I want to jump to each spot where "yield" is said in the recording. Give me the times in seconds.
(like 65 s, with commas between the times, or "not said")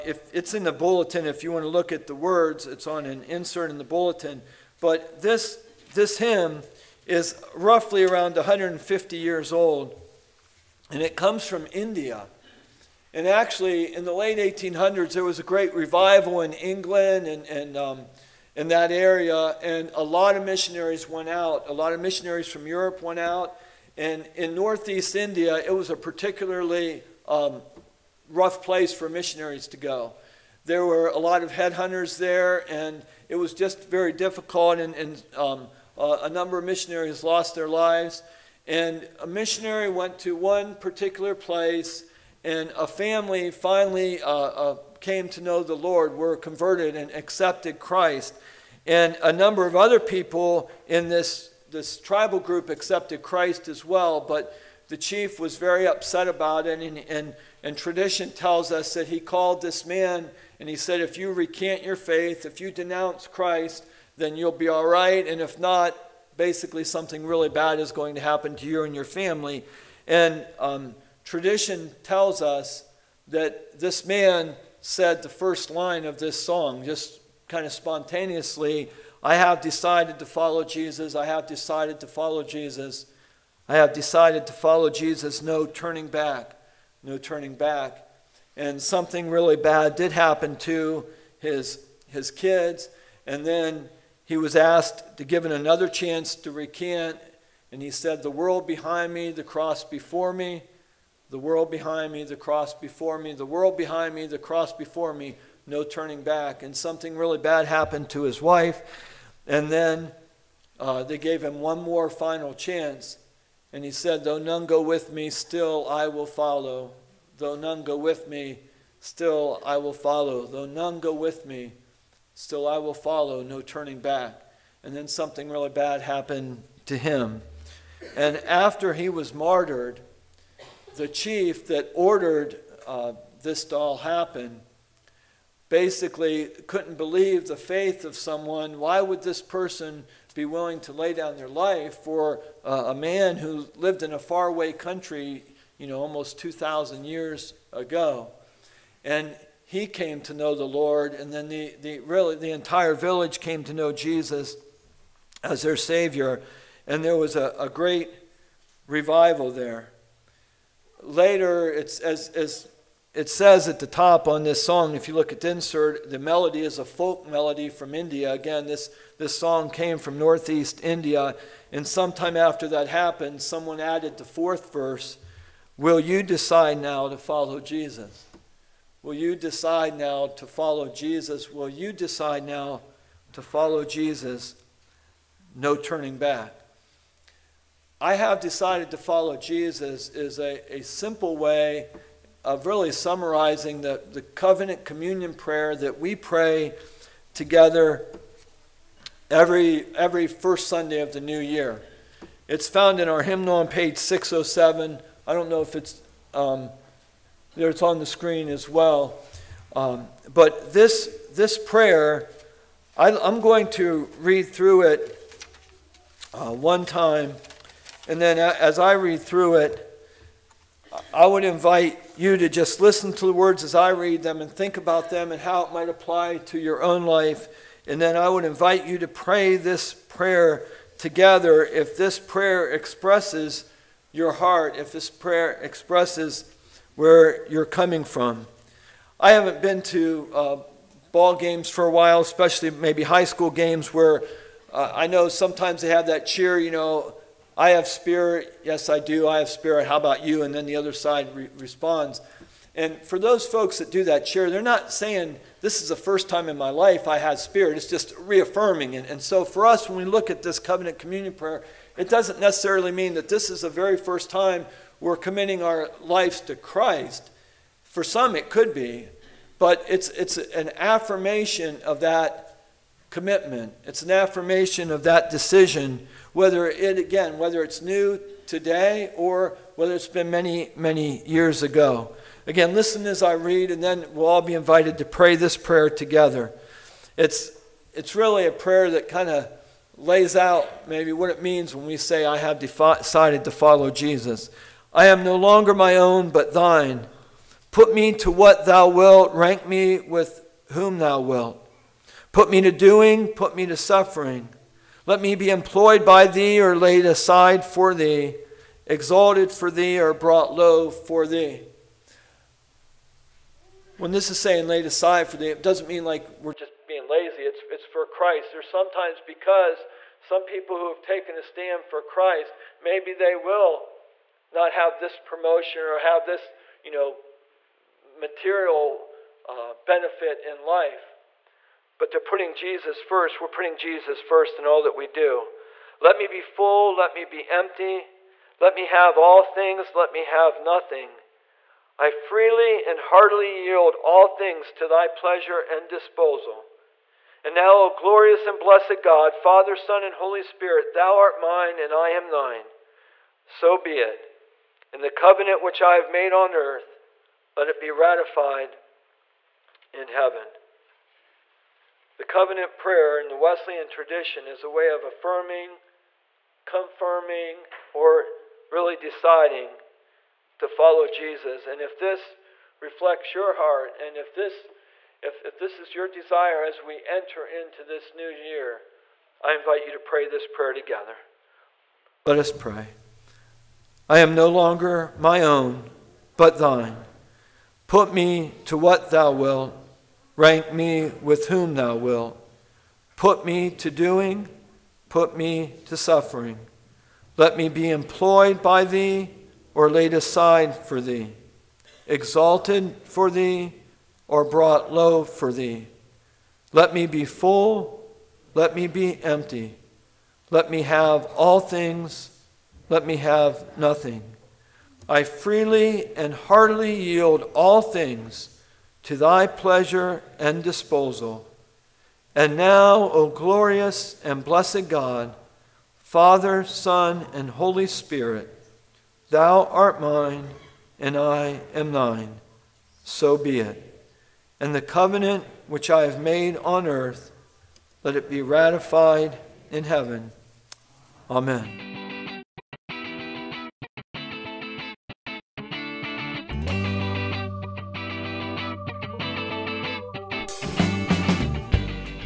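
343 s, 416 s.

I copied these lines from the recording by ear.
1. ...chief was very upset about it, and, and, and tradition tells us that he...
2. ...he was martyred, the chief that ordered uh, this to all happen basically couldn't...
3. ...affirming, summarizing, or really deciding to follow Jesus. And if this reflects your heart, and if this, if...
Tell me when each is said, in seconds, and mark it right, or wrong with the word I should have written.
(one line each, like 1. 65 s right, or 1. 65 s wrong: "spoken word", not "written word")
1. 54 s right
2. 128 s right
3. 365 s wrong: "confirming", not "summarizing".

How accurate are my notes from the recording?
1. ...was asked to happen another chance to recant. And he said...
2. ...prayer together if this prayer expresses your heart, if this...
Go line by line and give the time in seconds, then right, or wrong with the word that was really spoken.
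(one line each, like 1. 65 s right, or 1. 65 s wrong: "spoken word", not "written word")
1. 94 s wrong: "given", not "happen"
2. 229 s right.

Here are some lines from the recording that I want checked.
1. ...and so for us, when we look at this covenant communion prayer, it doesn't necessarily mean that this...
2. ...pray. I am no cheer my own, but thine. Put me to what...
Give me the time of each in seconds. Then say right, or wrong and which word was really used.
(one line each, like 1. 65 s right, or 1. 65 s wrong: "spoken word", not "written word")
1. 259 s right
2. 382 s wrong: "longer", not "cheer".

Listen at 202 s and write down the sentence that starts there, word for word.
It's found in our hymnal on page 607.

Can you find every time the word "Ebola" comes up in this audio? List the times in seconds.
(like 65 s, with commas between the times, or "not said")
not said.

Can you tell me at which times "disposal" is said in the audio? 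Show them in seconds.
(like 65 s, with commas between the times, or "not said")
345 s, 420 s.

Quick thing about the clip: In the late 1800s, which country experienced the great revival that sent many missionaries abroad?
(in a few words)
England.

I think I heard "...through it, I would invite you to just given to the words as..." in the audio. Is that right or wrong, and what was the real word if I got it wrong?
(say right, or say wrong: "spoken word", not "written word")
wrong: "listen", not "given".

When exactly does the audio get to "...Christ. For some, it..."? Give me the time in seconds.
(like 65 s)
266 s.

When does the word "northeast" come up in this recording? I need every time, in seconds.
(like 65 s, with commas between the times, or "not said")
24 s, 170 s.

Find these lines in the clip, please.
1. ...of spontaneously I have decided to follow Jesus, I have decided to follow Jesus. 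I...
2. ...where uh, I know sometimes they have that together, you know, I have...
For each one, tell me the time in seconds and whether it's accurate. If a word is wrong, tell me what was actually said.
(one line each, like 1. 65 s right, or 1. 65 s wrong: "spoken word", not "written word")
1. 77 s right
2. 243 s wrong: "cheer", not "together".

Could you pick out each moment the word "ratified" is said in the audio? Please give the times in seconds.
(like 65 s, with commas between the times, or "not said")
357 s, 438 s.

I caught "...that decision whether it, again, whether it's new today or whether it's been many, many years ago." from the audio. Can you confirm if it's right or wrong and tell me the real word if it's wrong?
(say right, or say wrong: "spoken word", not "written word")
right.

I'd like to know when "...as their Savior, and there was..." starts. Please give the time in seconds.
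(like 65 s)
155 s.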